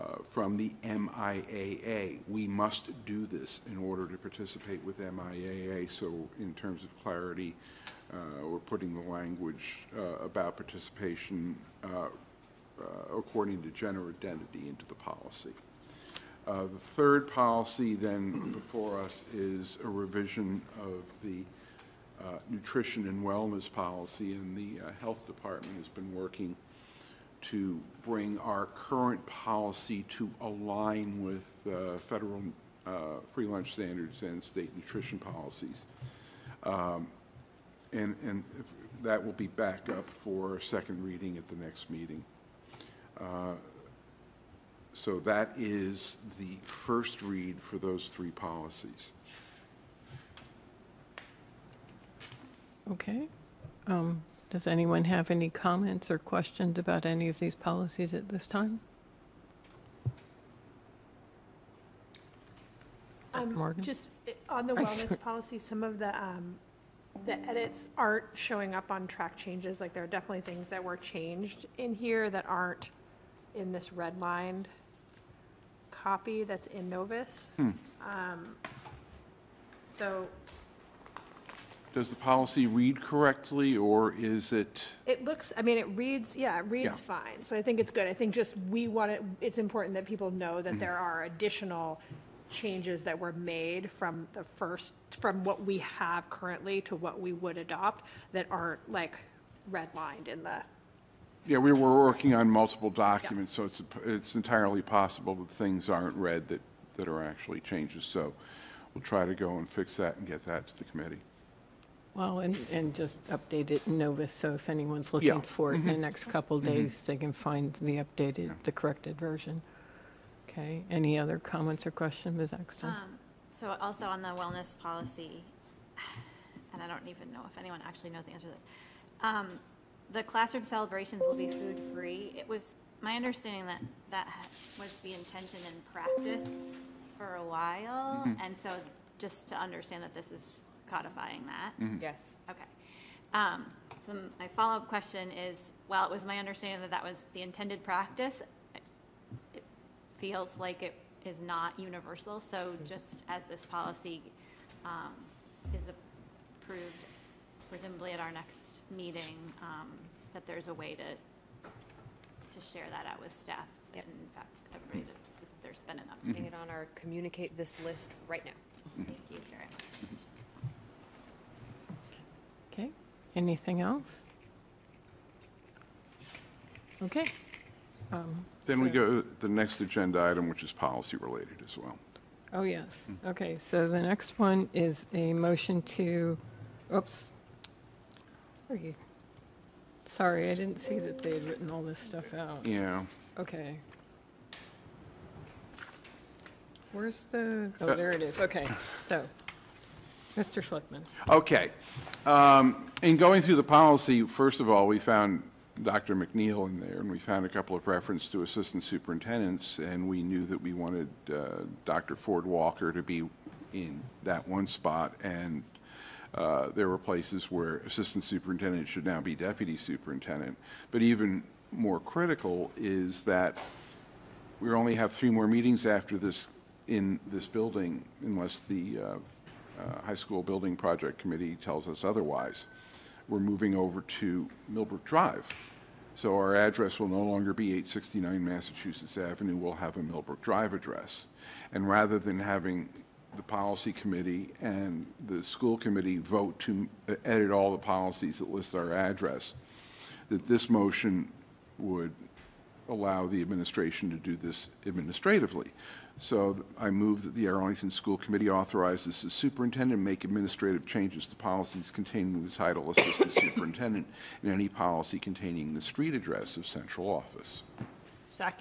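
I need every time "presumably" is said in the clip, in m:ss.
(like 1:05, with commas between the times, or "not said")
2:37.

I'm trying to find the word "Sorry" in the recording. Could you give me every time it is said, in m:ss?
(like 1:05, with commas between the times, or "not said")
3:10.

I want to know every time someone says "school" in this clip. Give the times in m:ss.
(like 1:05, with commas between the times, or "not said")
3:50, 4:05, 4:17.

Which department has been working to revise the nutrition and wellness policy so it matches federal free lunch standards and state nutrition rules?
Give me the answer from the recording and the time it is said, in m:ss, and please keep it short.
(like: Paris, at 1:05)
The health department, at 0:25.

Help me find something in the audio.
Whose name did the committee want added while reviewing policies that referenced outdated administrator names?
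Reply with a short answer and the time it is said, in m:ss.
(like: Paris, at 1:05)
Dr. Ford Walker, at 3:31.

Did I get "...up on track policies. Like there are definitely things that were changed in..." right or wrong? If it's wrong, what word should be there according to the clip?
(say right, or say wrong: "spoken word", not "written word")
wrong: "changes", not "policies".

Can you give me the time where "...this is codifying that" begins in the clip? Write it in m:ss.
2:20.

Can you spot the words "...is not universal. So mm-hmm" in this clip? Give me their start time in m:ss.
2:31.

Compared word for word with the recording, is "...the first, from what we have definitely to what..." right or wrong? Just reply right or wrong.
wrong.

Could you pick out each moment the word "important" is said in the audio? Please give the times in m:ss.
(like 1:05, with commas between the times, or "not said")
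1:29.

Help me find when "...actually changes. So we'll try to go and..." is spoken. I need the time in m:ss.
1:47.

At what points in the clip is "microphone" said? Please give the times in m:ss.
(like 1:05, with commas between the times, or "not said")
not said.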